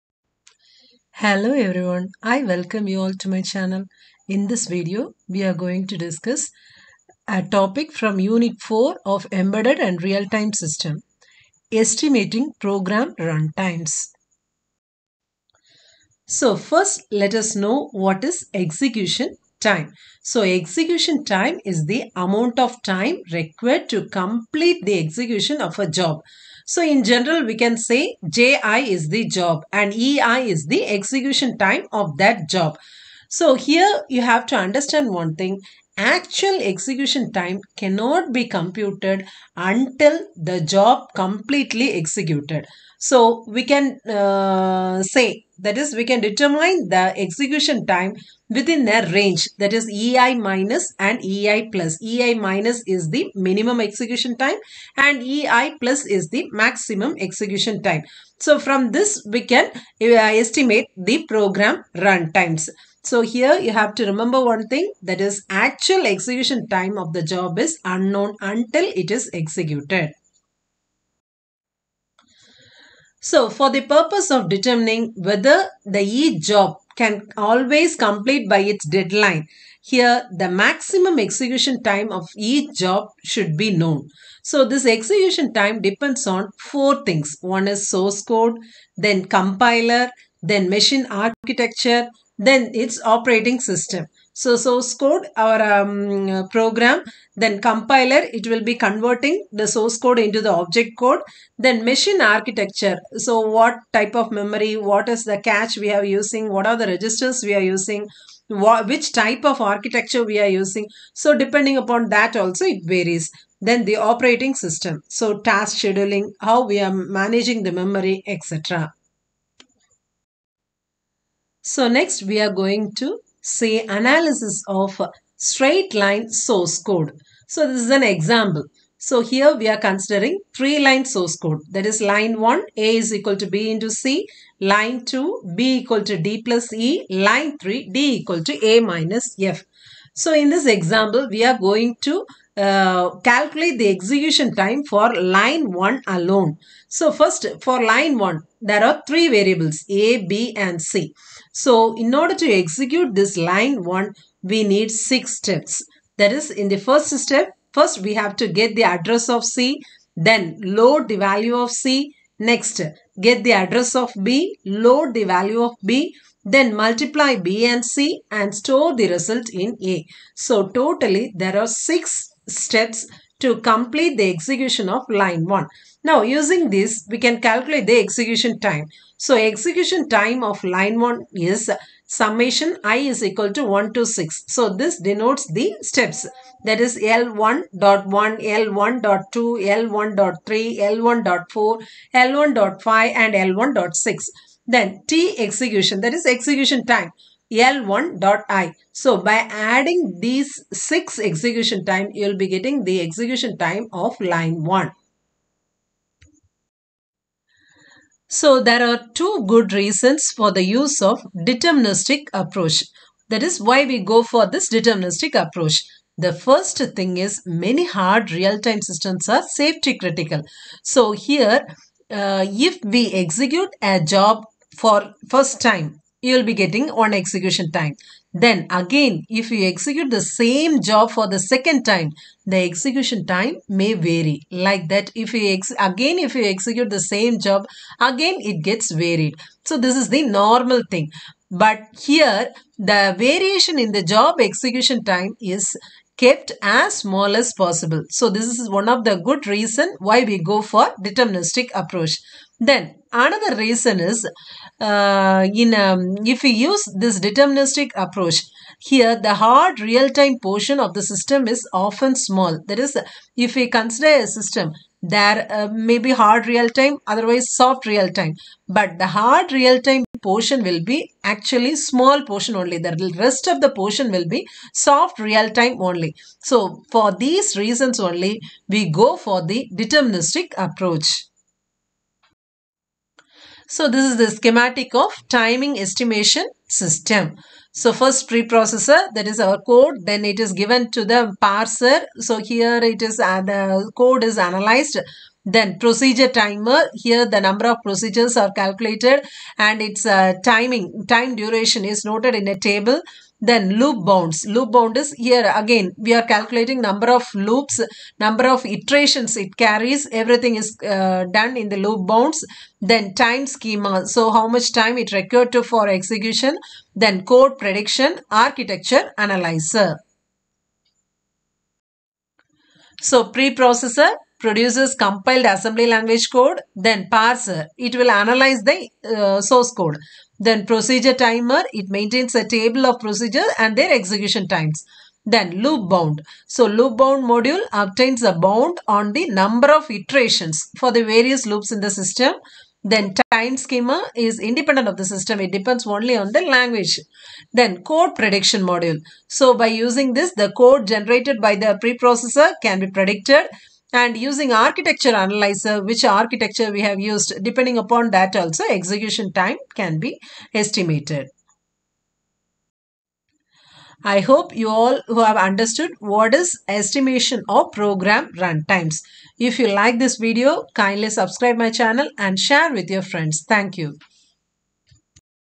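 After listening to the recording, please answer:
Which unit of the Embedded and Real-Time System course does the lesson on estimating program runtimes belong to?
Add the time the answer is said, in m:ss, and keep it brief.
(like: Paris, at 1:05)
Unit 4, at 0:08.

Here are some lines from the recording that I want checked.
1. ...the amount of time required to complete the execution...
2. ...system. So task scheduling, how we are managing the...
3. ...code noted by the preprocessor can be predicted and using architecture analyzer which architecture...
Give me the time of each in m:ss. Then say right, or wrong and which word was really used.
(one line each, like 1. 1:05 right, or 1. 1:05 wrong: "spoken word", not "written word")
1. 0:21 right
2. 1:54 right
3. 5:50 wrong: "generated", not "noted".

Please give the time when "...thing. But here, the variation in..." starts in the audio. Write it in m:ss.
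4:00.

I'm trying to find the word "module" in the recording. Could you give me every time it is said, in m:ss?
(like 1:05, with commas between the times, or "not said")
5:37, 5:48.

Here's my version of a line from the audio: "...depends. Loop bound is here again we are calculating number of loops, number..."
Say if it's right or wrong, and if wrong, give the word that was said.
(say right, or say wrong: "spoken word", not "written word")
wrong: "bounds", not "depends".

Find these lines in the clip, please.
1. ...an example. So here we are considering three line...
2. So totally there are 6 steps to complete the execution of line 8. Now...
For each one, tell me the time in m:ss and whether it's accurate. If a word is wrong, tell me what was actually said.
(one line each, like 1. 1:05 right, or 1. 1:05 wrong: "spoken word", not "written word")
1. 2:07 right
2. 2:50 wrong: "1", not "8".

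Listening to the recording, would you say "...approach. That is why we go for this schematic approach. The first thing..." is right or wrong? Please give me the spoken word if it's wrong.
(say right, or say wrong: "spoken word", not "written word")
wrong: "deterministic", not "schematic".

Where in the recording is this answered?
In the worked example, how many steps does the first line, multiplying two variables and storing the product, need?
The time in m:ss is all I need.
2:34.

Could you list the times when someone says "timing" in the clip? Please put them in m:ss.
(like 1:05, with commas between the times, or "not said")
4:45, 5:00.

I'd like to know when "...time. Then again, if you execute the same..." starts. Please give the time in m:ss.
3:47.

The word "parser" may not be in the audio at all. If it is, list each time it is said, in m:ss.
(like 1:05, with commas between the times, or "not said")
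4:51, 5:27.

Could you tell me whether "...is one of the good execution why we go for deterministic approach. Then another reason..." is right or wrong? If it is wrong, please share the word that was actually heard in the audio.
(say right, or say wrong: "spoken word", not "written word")
wrong: "reason", not "execution".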